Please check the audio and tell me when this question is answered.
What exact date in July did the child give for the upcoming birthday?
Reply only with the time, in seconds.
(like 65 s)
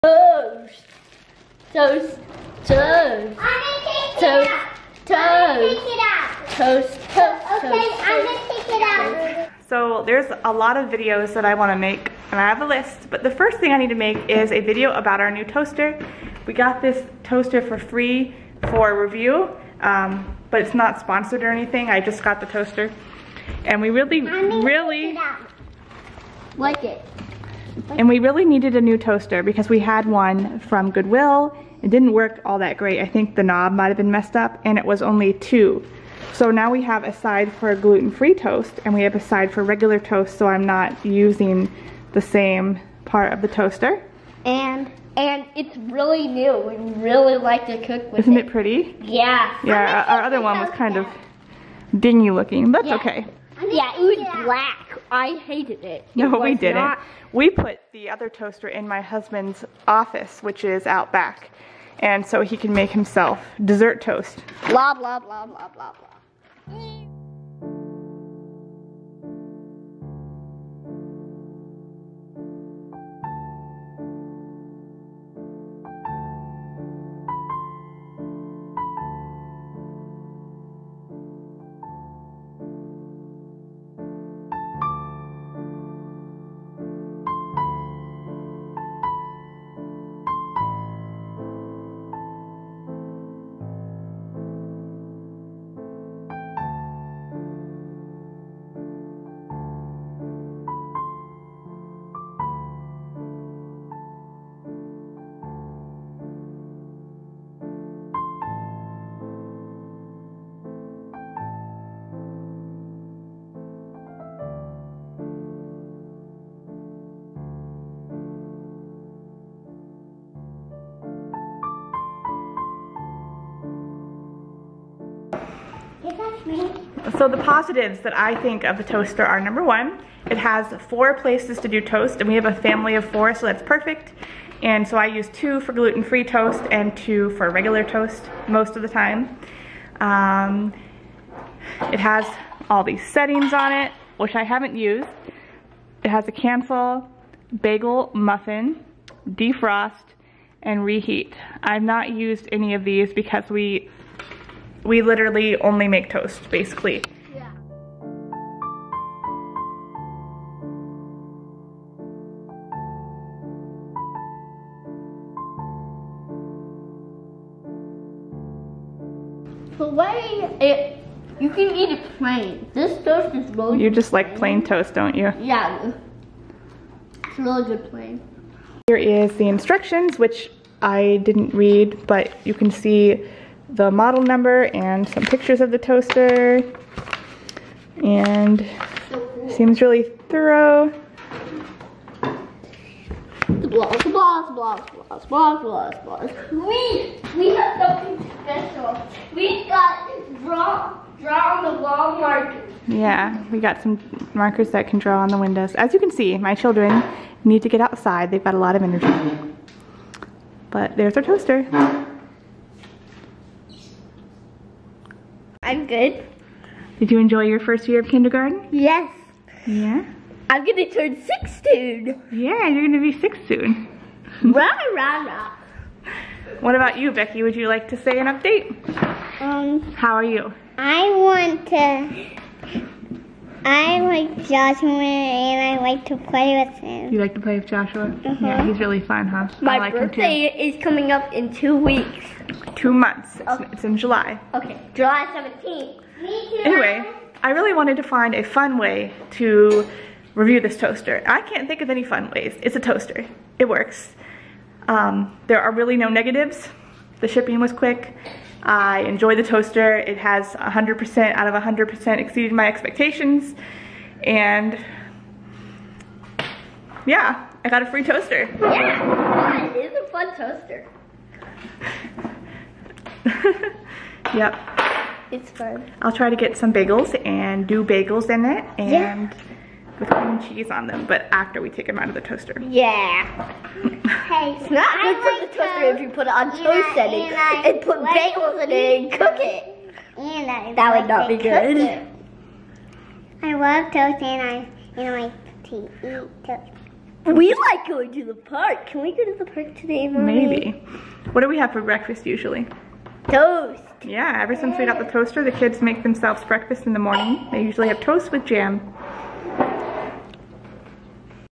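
244 s.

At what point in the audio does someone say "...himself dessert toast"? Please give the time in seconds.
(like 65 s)
62 s.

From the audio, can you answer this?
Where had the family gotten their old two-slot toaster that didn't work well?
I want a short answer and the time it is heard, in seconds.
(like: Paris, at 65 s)
Goodwill, at 30 s.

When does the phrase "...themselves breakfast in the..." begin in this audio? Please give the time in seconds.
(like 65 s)
306 s.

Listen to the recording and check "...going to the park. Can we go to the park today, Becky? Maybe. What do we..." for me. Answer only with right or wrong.
wrong.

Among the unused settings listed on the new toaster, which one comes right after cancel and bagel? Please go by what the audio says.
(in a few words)
Muffin.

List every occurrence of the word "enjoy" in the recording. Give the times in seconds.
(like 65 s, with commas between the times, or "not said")
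217 s, 259 s.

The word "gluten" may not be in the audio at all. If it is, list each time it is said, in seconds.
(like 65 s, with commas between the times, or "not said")
37 s, 135 s.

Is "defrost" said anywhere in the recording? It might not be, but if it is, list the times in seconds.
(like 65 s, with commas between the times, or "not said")
149 s.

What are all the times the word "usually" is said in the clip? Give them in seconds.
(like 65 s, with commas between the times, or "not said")
302 s, 307 s.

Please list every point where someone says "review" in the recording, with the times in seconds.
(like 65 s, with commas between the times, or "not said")
19 s, 250 s.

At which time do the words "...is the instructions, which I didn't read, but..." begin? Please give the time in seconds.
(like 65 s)
178 s.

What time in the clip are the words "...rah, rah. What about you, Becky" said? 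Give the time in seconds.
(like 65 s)
224 s.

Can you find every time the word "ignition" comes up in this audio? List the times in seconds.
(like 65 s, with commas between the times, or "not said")
not said.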